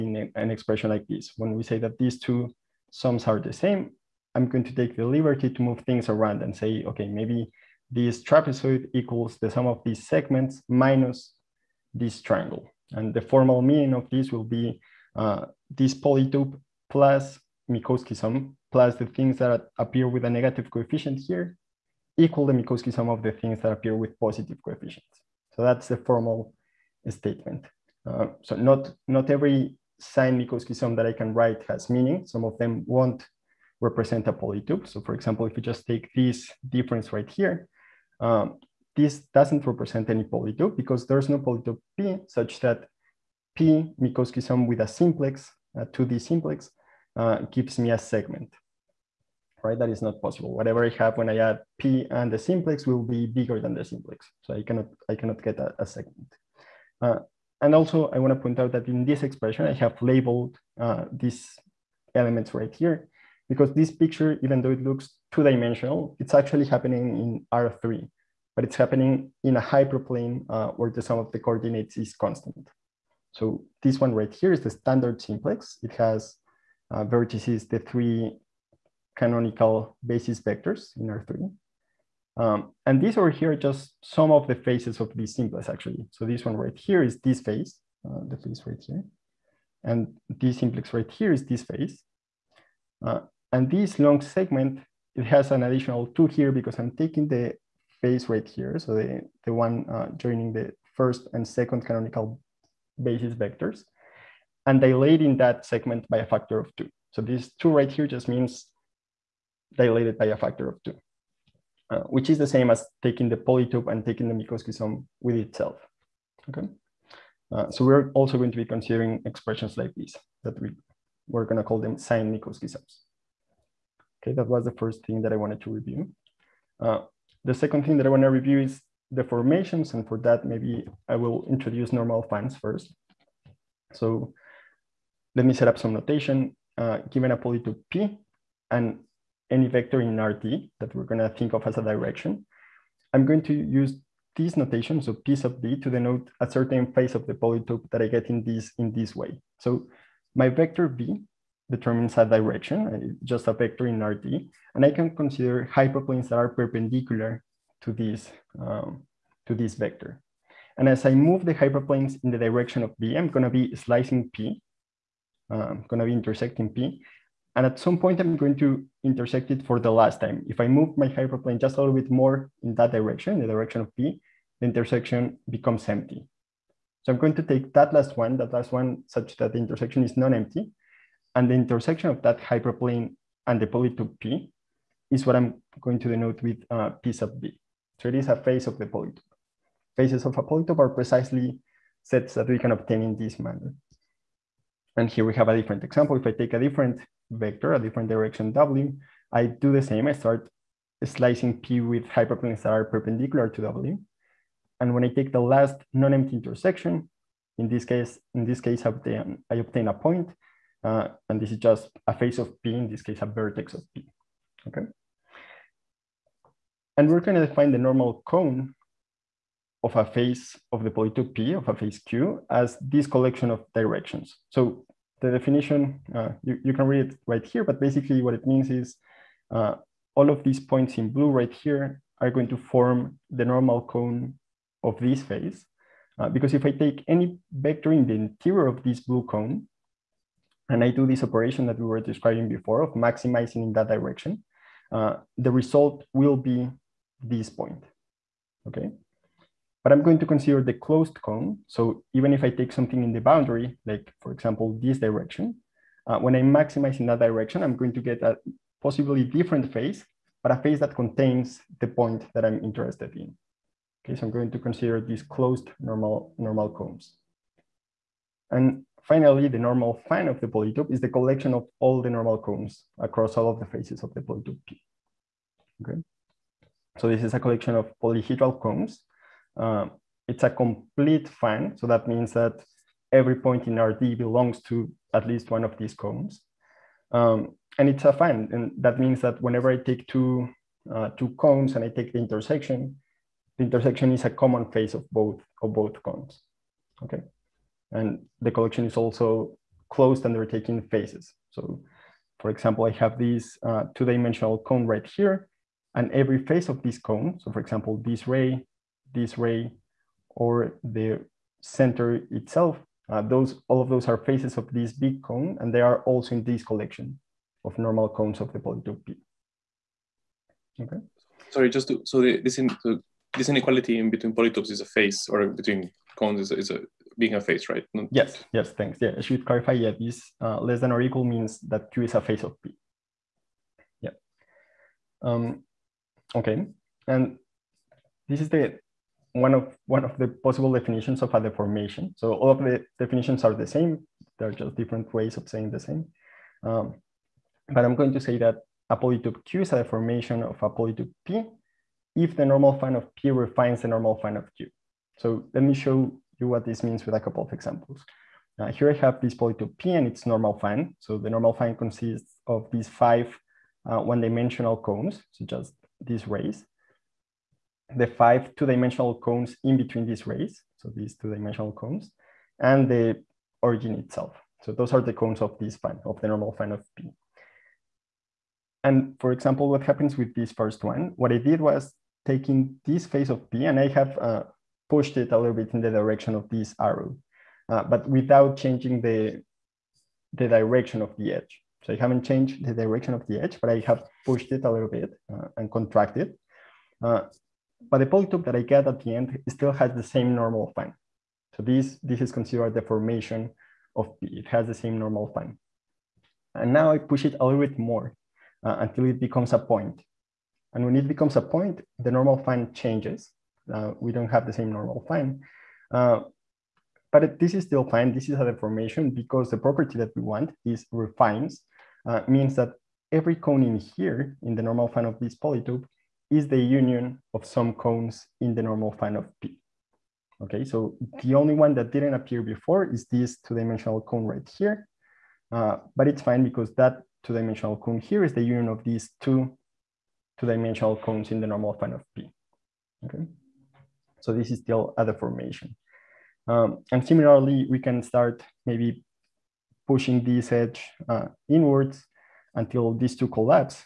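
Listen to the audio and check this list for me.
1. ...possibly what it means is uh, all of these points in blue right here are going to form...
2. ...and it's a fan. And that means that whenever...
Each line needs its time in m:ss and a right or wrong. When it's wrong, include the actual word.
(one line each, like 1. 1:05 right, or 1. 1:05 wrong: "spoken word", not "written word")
1. 3:47 wrong: "basically", not "possibly"
2. 4:47 right.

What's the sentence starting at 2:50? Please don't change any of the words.
If I move my hyperplane just a little bit more in that direction, the direction of P, the intersection becomes empty.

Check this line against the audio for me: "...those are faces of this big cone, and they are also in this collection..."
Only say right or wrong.
right.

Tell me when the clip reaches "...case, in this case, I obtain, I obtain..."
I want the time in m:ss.
3:27.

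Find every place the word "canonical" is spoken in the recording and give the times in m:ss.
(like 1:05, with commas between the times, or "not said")
1:19, 1:41.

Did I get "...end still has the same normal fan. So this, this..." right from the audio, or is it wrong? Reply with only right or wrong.
right.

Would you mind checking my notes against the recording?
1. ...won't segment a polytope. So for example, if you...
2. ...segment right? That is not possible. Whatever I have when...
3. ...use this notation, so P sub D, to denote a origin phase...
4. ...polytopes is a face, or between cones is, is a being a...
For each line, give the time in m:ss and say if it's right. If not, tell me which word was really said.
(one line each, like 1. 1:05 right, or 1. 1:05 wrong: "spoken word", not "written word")
1. 0:32 wrong: "represent", not "segment"
2. 0:47 right
3. 2:23 wrong: "certain", not "origin"
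4. 5:24 right.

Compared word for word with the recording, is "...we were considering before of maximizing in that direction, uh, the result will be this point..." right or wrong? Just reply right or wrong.
wrong.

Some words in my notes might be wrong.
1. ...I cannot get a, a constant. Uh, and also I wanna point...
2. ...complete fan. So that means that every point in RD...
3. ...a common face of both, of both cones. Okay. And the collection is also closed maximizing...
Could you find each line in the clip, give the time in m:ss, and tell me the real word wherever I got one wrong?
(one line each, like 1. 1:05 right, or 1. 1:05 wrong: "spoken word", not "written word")
1. 0:55 wrong: "segment", not "constant"
2. 4:40 right
3. 4:54 wrong: "taking", not "maximizing".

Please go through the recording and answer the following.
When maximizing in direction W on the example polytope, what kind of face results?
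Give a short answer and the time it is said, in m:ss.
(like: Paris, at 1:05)
a vertex, at 3:33.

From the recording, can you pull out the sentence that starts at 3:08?
So it is a phase of the polytope.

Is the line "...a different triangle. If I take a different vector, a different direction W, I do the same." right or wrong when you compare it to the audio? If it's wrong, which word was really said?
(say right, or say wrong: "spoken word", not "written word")
wrong: "example", not "triangle".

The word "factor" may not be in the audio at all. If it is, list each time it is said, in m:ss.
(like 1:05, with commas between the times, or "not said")
1:46, 1:50.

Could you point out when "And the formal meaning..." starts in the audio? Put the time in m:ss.
0:12.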